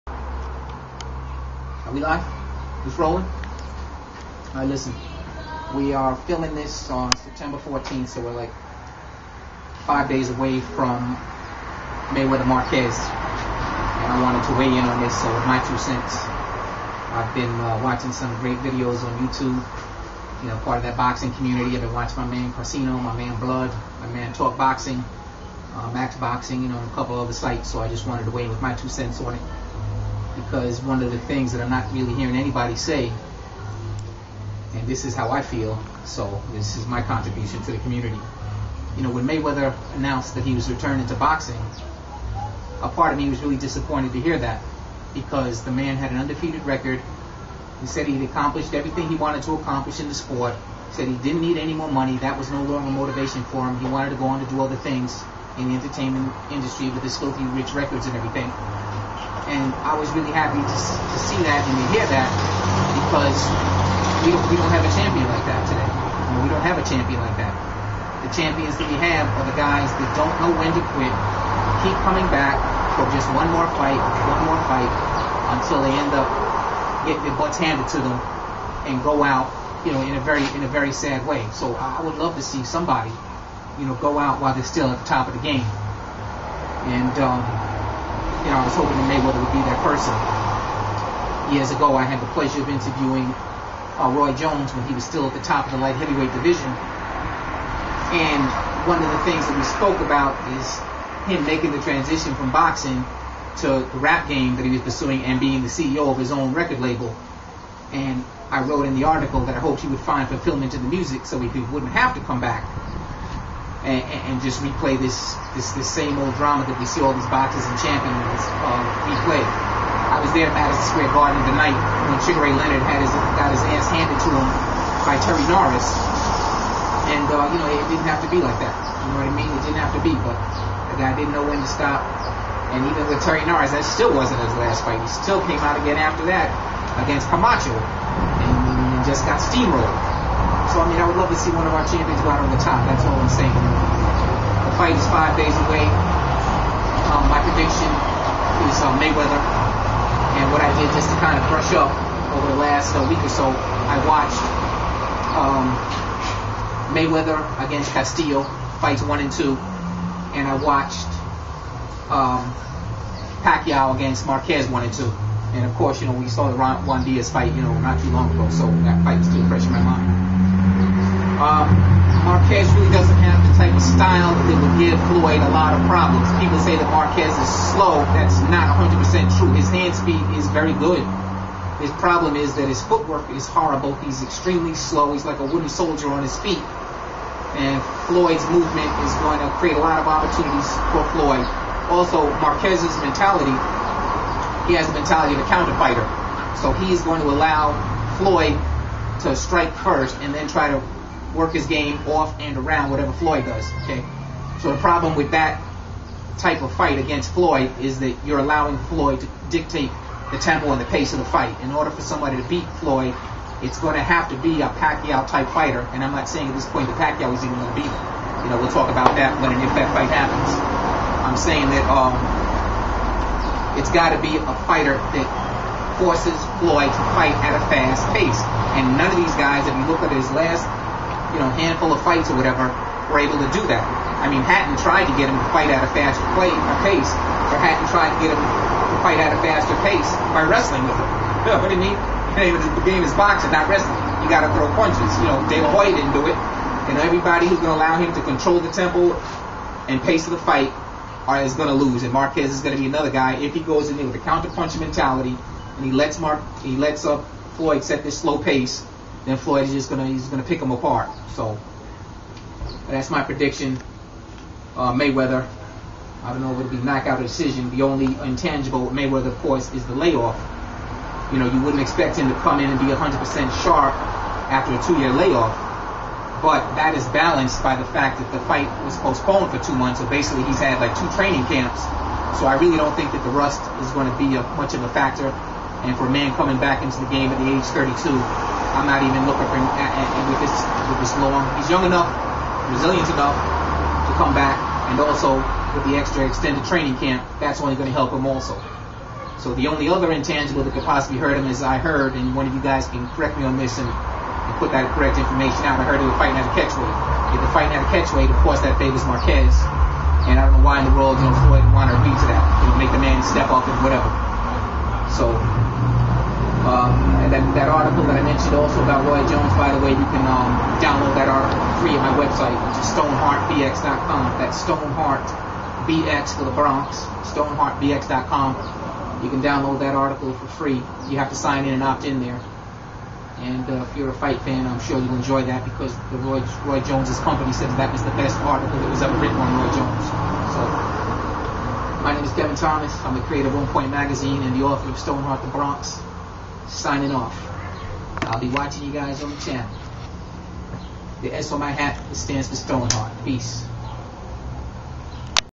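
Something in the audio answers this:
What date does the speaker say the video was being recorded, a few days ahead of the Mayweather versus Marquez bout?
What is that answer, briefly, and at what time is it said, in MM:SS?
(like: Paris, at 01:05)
September 14th, at 00:07.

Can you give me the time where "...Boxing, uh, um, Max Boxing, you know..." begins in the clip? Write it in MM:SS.
00:24.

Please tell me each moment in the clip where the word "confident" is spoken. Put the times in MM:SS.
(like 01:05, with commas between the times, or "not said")
not said.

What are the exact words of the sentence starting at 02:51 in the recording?
Um, Marquez really doesn't have the type of style that would give Floyd a lot of problems.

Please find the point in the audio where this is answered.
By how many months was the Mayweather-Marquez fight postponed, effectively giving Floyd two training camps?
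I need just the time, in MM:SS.
04:39.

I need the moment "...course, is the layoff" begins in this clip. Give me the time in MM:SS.
04:29.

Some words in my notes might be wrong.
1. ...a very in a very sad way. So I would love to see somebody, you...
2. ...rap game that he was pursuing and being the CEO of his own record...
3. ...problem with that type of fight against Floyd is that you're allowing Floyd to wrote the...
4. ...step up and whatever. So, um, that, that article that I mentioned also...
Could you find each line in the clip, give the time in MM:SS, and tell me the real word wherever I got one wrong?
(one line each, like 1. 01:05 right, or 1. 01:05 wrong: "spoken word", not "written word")
1. 01:20 right
2. 01:44 right
3. 03:24 wrong: "dictate", not "wrote"
4. 05:13 right.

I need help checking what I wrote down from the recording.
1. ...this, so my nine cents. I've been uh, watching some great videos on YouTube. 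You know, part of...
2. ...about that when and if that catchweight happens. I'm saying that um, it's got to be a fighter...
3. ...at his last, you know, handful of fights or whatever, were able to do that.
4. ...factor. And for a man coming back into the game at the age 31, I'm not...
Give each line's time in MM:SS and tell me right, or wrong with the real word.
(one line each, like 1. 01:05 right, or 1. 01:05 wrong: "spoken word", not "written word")
1. 00:15 wrong: "two", not "nine"
2. 03:38 wrong: "fight", not "catchweight"
3. 03:50 right
4. 04:44 wrong: "32", not "31".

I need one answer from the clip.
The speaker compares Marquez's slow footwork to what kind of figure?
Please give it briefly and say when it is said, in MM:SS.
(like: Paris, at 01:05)
a wooden soldier, at 03:05.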